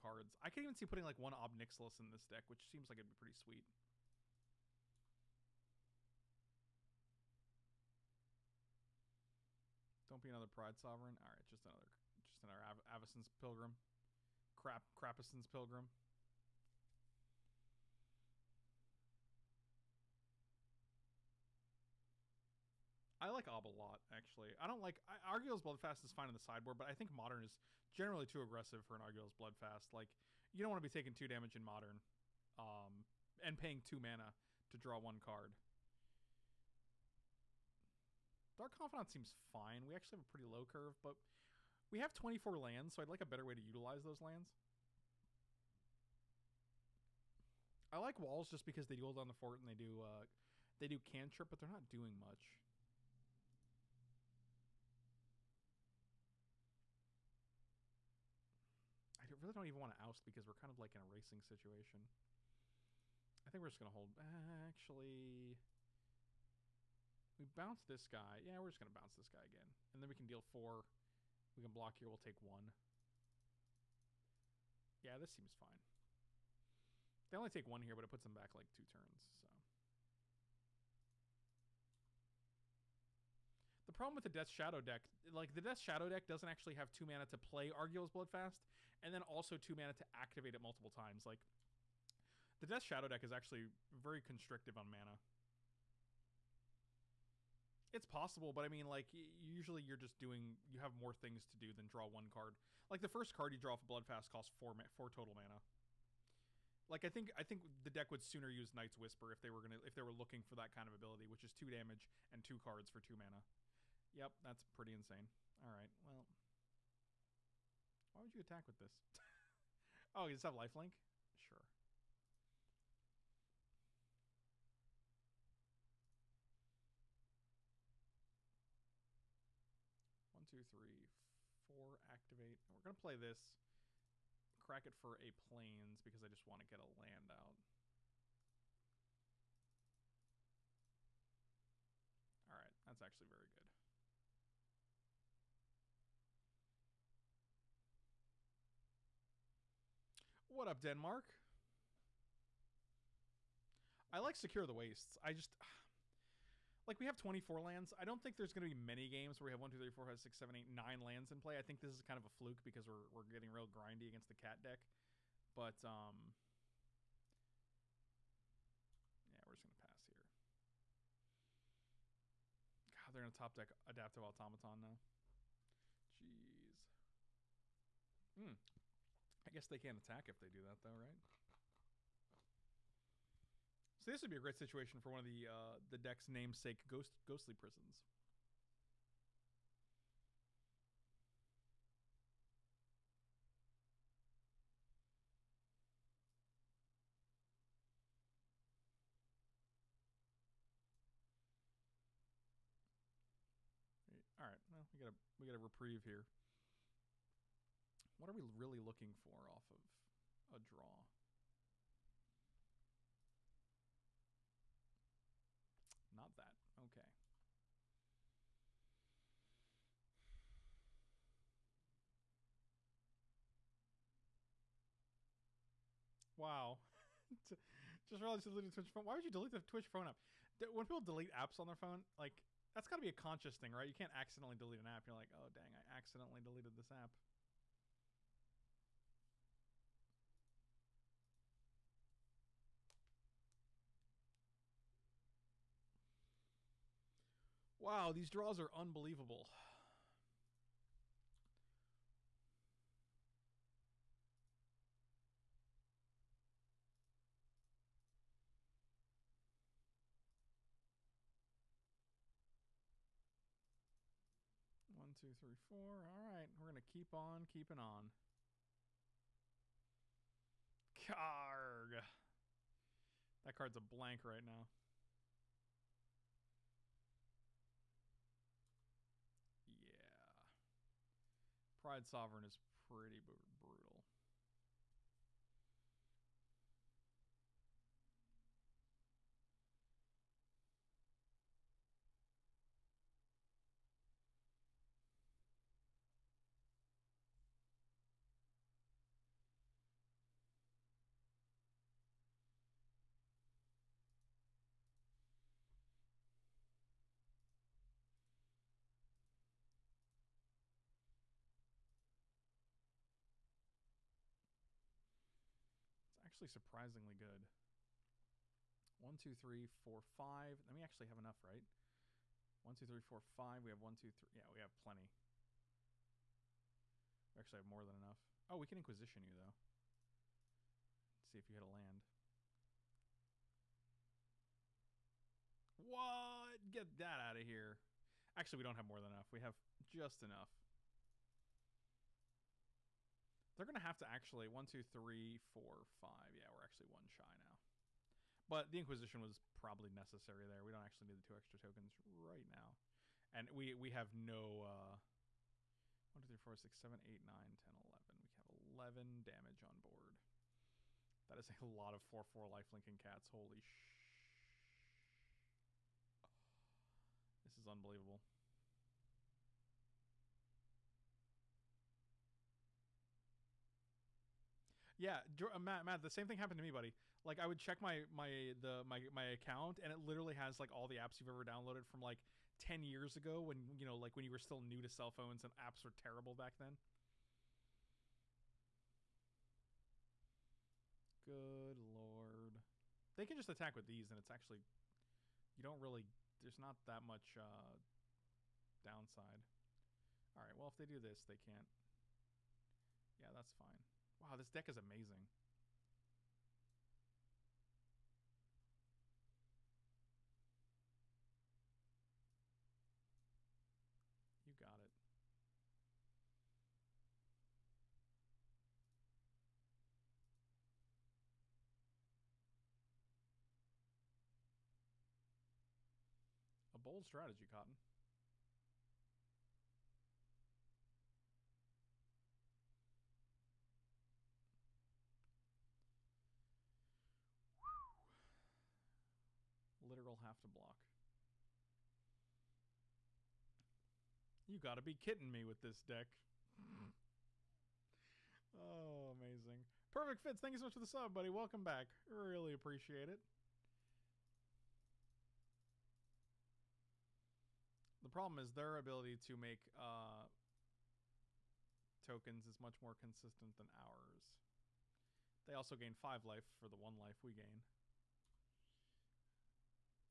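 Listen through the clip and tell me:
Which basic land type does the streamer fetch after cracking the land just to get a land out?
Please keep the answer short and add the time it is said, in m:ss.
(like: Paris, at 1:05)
Plains, at 2:15.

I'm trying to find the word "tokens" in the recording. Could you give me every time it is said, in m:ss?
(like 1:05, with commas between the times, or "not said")
5:51, 7:42.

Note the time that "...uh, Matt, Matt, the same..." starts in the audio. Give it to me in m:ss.
6:15.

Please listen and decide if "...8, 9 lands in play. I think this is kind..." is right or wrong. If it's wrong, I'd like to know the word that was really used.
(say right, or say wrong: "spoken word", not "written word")
right.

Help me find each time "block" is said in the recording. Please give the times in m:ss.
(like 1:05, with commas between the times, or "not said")
1:11, 7:20.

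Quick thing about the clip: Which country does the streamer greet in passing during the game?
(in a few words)
Denmark.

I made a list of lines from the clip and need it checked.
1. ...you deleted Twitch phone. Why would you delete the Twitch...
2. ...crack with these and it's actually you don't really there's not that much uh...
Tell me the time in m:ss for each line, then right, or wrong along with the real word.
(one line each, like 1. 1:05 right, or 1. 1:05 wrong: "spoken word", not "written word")
1. 3:48 right
2. 6:33 wrong: "attack", not "crack".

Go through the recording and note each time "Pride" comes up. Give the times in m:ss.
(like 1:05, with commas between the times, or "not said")
0:10, 4:41.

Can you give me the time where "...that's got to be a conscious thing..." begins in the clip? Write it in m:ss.
3:52.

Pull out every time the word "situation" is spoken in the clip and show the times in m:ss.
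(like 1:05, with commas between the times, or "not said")
1:01, 3:04.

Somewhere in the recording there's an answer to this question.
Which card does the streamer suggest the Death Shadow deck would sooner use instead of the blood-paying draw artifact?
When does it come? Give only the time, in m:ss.
1:48.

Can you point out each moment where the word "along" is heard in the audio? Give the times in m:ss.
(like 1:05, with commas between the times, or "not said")
not said.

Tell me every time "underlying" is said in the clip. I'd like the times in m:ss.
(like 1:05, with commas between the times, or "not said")
not said.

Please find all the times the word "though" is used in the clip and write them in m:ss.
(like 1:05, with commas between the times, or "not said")
3:00, 5:29.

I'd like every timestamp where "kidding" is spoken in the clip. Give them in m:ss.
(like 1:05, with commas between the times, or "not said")
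7:24.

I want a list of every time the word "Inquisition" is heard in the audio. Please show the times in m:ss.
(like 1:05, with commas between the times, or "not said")
5:28, 5:48.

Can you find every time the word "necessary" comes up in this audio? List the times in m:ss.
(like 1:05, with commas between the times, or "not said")
5:49.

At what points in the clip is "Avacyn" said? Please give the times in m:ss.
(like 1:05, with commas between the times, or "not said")
0:12.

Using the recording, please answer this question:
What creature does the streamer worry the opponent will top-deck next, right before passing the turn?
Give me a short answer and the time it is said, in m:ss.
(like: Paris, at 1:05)
Adaptive Automaton, at 2:53.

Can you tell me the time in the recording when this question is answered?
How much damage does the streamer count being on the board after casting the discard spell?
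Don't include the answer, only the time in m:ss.
5:58.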